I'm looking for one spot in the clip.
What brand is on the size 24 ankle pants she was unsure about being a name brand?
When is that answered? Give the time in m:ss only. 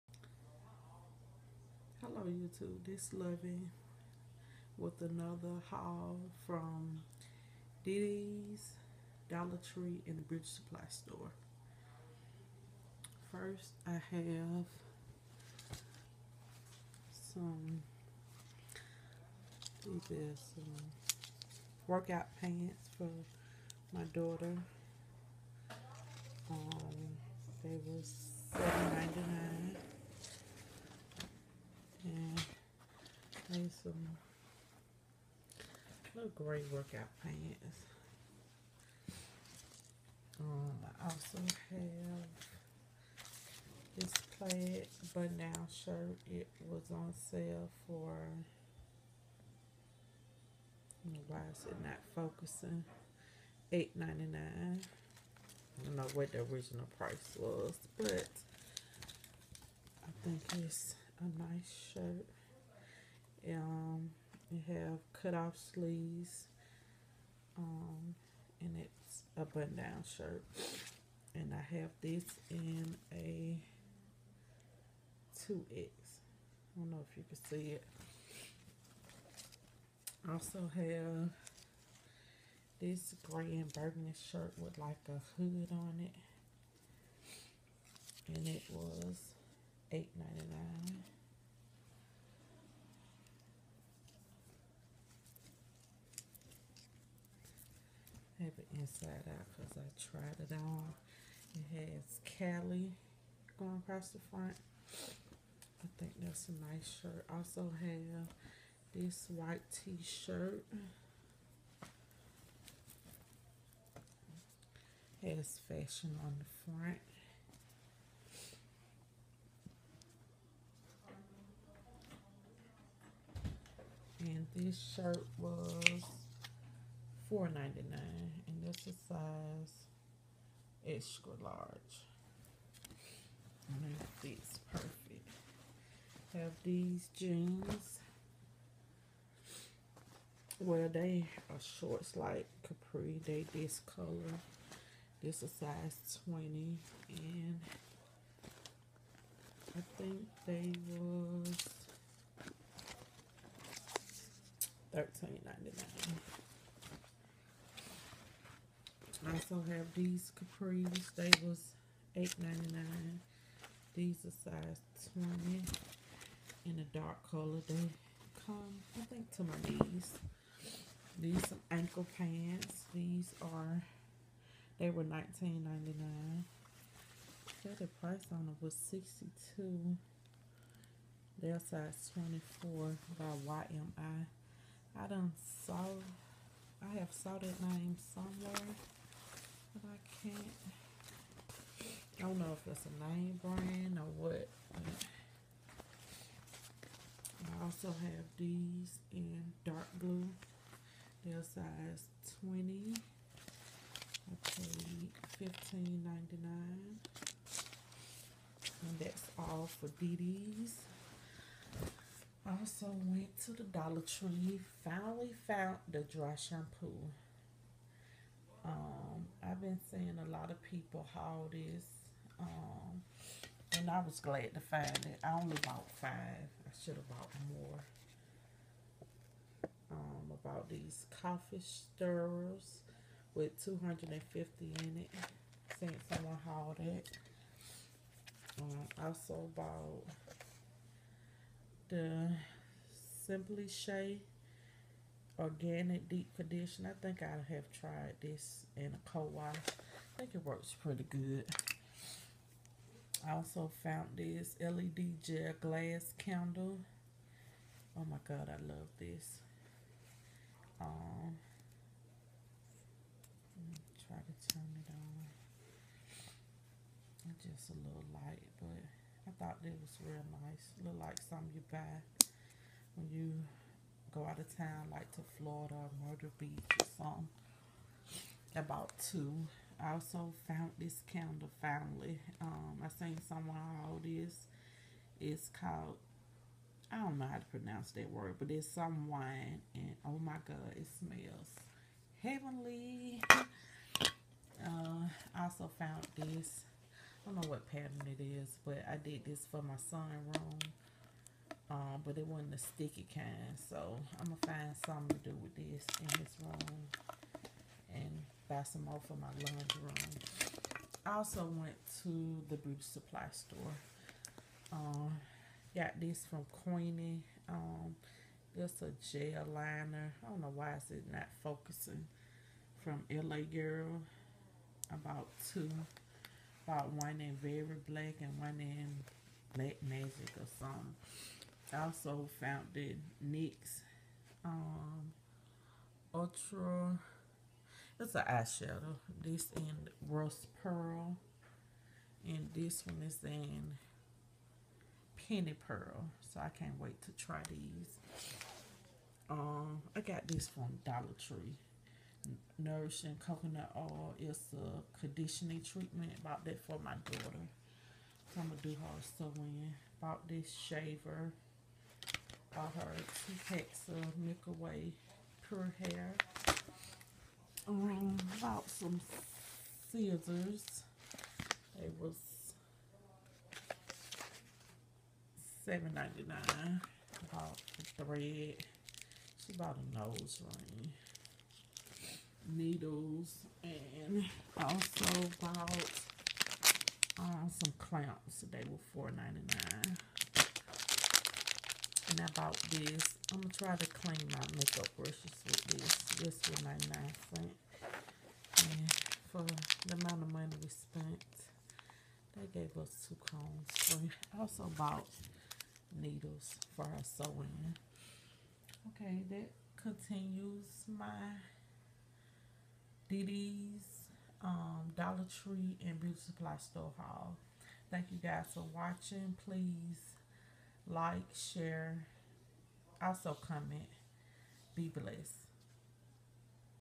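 3:03.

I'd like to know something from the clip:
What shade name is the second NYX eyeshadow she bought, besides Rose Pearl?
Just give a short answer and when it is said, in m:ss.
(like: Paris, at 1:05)
Penny Pearl, at 5:45.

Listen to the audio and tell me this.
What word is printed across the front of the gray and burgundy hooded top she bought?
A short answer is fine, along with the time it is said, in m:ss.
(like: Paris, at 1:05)
Cali, at 1:42.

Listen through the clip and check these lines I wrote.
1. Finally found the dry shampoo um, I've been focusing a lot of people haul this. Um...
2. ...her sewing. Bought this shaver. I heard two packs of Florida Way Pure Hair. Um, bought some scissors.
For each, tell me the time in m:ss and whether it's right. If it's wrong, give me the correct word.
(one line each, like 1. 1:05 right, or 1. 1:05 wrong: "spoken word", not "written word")
1. 3:34 wrong: "seeing", not "focusing"
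2. 5:58 wrong: "Milky", not "Florida".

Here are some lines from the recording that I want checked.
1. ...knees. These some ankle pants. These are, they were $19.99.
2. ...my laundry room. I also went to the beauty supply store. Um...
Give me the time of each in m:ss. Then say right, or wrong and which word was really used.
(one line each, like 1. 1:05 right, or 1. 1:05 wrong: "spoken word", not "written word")
1. 2:49 right
2. 5:09 right.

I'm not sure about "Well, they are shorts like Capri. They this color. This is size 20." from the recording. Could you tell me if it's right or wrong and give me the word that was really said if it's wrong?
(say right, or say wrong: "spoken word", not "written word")
right.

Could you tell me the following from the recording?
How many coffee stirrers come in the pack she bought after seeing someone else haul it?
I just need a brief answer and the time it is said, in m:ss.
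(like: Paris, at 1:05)
250, at 3:53.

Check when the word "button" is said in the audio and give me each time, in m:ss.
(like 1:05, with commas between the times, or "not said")
0:45, 1:09.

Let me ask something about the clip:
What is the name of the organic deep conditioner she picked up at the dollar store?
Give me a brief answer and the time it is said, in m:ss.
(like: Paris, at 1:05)
Simply Shea, at 4:03.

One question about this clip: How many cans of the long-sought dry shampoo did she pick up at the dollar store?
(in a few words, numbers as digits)
5.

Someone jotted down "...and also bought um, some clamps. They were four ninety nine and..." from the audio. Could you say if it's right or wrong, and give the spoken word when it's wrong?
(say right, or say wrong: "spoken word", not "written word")
right.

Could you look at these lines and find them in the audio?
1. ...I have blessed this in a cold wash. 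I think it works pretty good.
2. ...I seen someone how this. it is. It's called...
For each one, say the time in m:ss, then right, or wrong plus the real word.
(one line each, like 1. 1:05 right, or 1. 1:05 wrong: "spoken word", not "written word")
1. 4:07 wrong: "tried", not "blessed"
2. 4:42 right.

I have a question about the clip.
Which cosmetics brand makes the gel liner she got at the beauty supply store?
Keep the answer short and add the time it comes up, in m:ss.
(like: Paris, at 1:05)
LA Girl, at 5:23.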